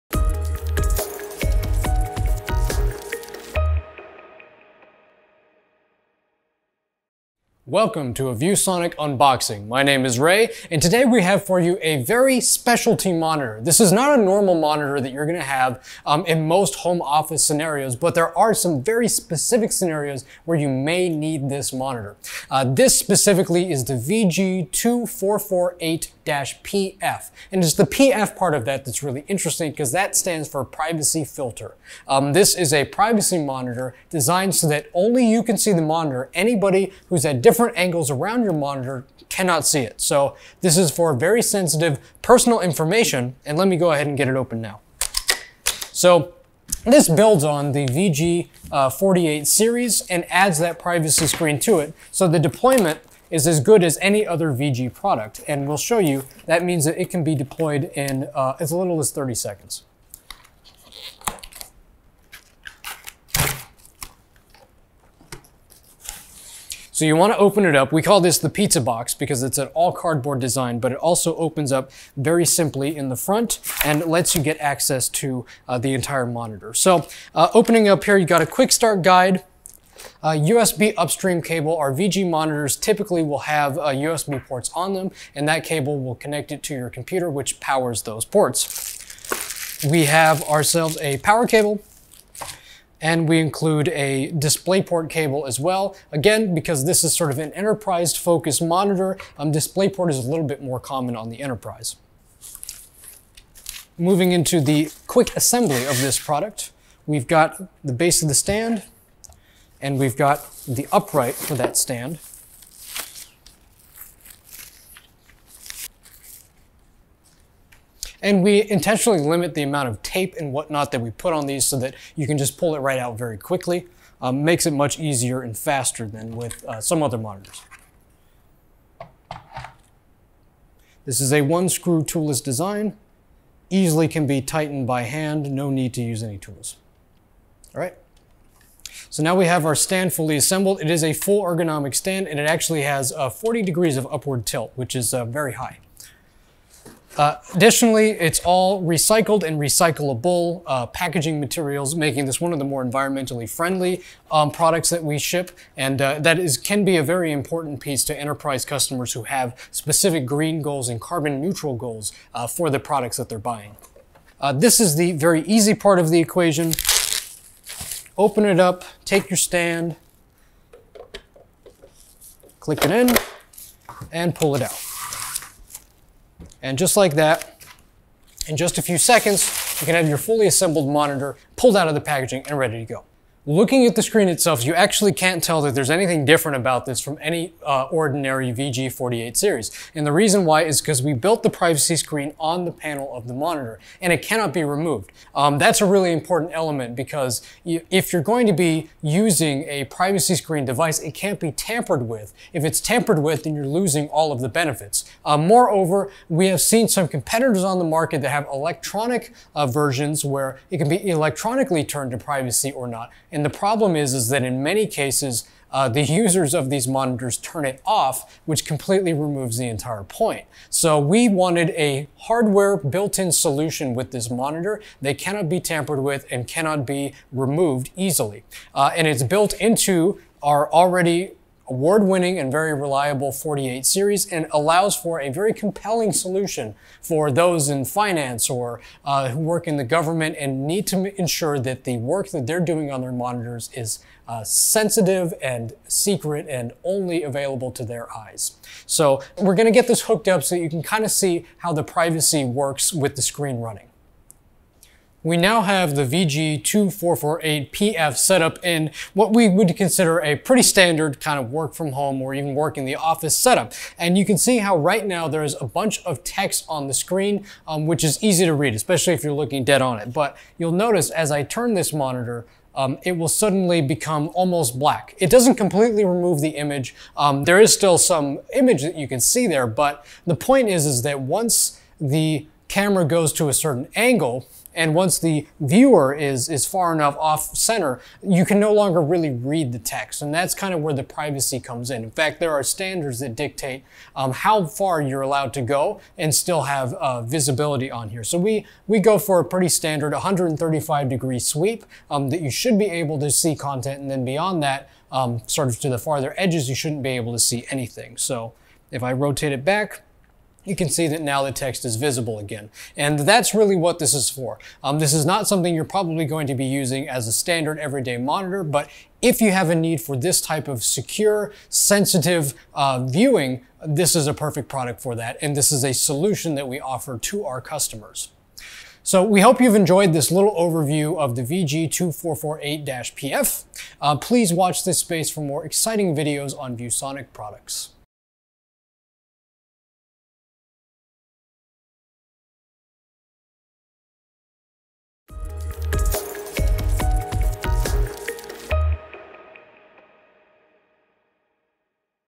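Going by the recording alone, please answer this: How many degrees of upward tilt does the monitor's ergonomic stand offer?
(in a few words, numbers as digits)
40.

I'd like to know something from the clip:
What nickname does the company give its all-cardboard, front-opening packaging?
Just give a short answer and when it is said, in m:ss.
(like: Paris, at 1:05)
the pizza box, at 1:08.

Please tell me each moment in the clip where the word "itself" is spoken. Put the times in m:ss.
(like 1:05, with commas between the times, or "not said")
3:04.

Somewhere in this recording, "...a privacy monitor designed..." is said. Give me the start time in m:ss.
0:32.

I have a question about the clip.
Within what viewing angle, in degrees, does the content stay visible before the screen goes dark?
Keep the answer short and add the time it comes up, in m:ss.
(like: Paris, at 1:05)
135 degrees, at 5:00.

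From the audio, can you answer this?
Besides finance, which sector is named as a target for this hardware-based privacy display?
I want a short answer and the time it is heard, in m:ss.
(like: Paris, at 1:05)
government, at 3:59.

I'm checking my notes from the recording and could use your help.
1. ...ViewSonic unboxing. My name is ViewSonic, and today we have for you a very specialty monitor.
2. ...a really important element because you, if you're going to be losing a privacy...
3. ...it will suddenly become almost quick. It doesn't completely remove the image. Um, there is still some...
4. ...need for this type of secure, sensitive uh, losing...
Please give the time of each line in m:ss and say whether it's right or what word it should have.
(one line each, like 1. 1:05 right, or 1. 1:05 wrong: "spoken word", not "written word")
1. 0:08 wrong: "Ray", not "ViewSonic"
2. 3:15 wrong: "using", not "losing"
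3. 4:33 wrong: "black", not "quick"
4. 5:19 wrong: "viewing", not "losing".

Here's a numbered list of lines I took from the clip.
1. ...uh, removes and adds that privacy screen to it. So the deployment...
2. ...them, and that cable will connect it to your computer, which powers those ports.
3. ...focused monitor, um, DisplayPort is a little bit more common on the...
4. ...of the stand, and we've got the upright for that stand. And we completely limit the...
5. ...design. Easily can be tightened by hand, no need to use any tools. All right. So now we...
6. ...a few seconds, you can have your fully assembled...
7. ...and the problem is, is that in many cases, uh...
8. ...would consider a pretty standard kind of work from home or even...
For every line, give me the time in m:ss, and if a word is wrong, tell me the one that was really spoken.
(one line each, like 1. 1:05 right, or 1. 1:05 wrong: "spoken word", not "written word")
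1. 0:49 wrong: "series", not "removes"
2. 1:24 right
3. 1:38 right
4. 1:48 wrong: "intentionally", not "completely"
5. 2:12 right
6. 2:58 right
7. 3:33 right
8. 4:19 right.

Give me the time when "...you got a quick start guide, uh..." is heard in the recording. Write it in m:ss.
1:18.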